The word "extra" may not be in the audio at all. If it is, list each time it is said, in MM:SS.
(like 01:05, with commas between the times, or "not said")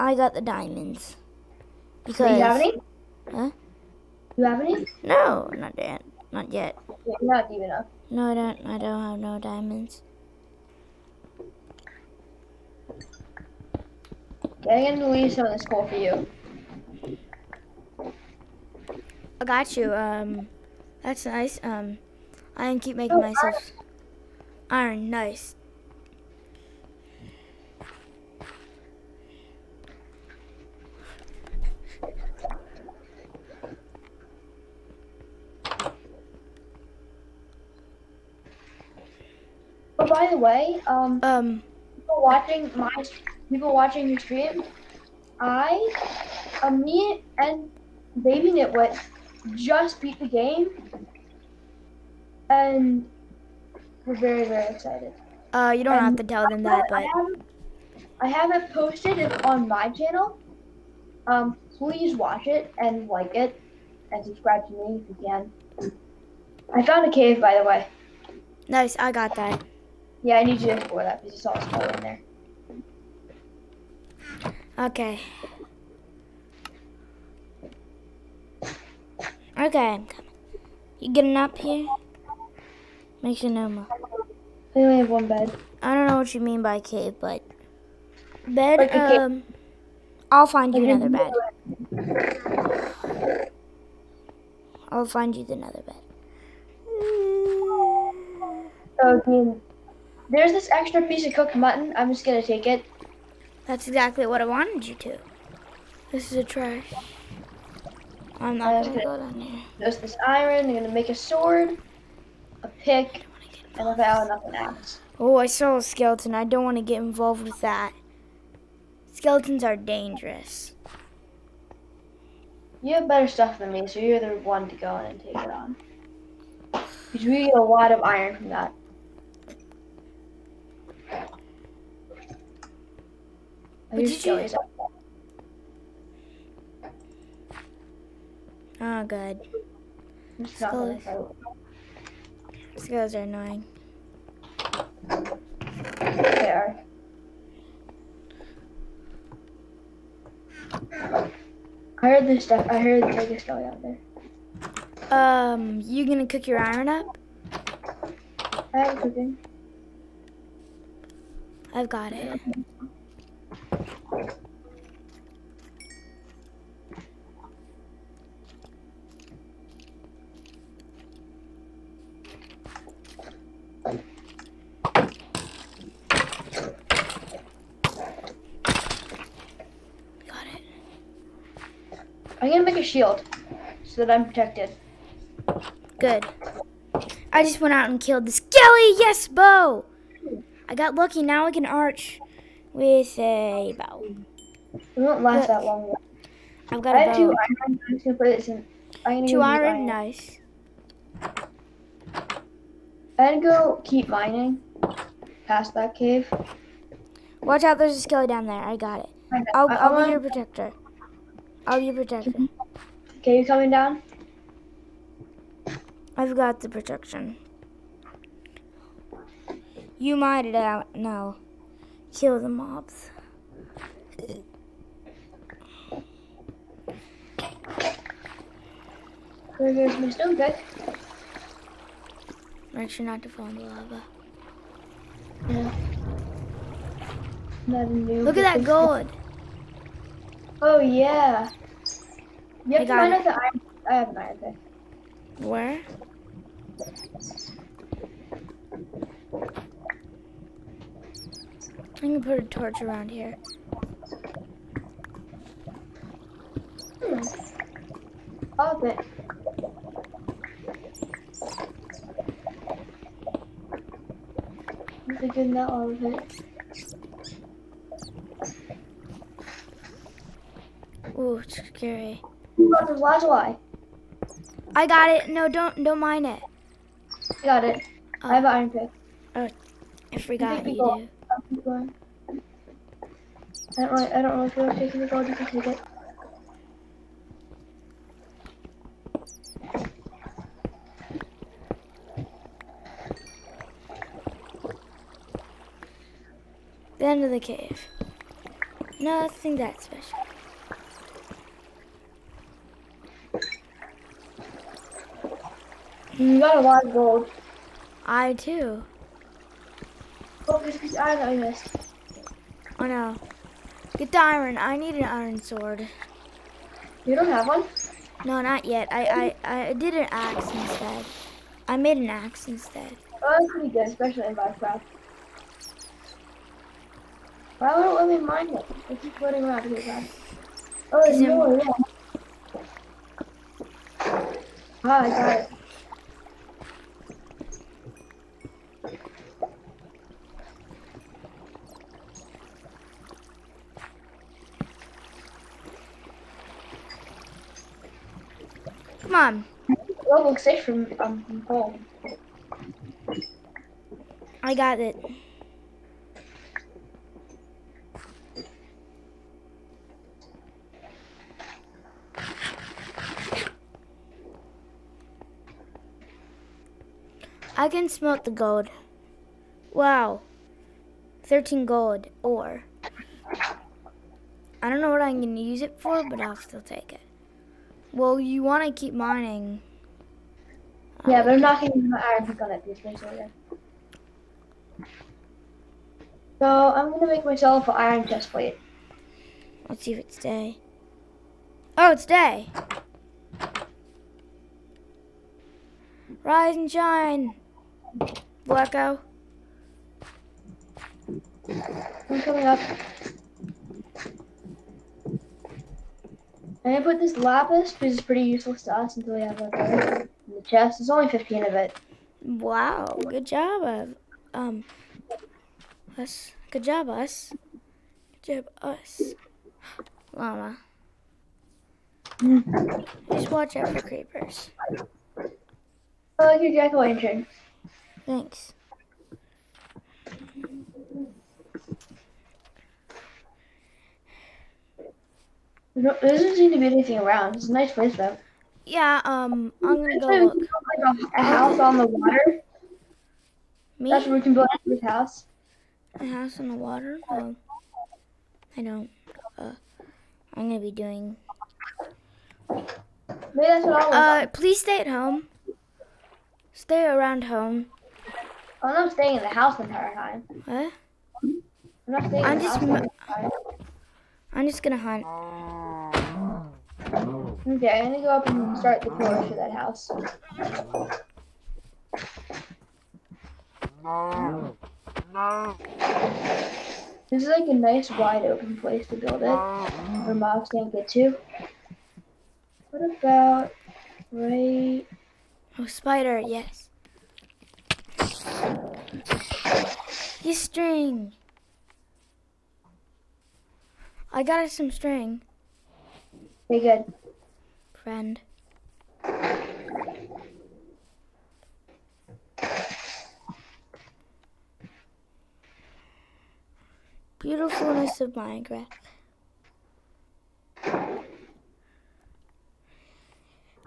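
01:40.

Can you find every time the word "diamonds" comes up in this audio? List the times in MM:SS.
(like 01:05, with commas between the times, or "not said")
00:00, 00:09.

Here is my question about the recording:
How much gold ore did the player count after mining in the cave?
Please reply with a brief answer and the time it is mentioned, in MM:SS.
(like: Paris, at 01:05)
13, at 06:11.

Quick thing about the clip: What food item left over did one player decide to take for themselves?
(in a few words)
Cooked mutton.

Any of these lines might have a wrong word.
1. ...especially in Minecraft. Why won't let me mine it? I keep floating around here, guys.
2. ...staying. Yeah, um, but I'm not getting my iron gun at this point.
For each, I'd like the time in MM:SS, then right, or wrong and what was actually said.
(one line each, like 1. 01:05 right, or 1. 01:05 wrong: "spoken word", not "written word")
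1. 05:23 right
2. 06:18 wrong: "mining", not "staying".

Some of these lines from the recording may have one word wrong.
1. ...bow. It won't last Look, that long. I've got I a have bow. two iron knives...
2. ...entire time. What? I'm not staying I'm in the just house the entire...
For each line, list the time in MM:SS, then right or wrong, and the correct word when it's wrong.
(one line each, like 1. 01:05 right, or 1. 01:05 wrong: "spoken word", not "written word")
1. 03:13 right
2. 07:39 right.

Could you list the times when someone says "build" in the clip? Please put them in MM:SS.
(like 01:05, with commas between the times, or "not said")
07:24, 07:58.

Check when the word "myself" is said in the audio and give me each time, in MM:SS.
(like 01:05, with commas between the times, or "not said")
00:23, 06:27.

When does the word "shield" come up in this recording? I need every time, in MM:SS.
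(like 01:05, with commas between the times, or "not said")
03:02.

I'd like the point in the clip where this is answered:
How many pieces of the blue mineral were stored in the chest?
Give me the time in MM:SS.
06:51.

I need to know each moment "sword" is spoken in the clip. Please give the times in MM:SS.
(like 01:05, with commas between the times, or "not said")
01:51, 05:15.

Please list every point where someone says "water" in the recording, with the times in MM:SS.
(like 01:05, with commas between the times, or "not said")
07:21, 07:26.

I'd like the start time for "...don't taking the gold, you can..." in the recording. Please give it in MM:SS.
04:44.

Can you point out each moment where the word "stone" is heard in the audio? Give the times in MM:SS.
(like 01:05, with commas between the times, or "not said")
03:50.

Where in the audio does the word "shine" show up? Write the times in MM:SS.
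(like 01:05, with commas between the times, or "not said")
06:36.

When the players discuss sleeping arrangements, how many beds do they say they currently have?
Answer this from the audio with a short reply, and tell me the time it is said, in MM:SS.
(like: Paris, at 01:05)
1, at 01:25.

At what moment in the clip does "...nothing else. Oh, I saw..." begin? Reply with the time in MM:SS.
01:54.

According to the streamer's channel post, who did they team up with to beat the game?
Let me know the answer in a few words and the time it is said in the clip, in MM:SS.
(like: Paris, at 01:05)
Baby Nitwit, at 00:48.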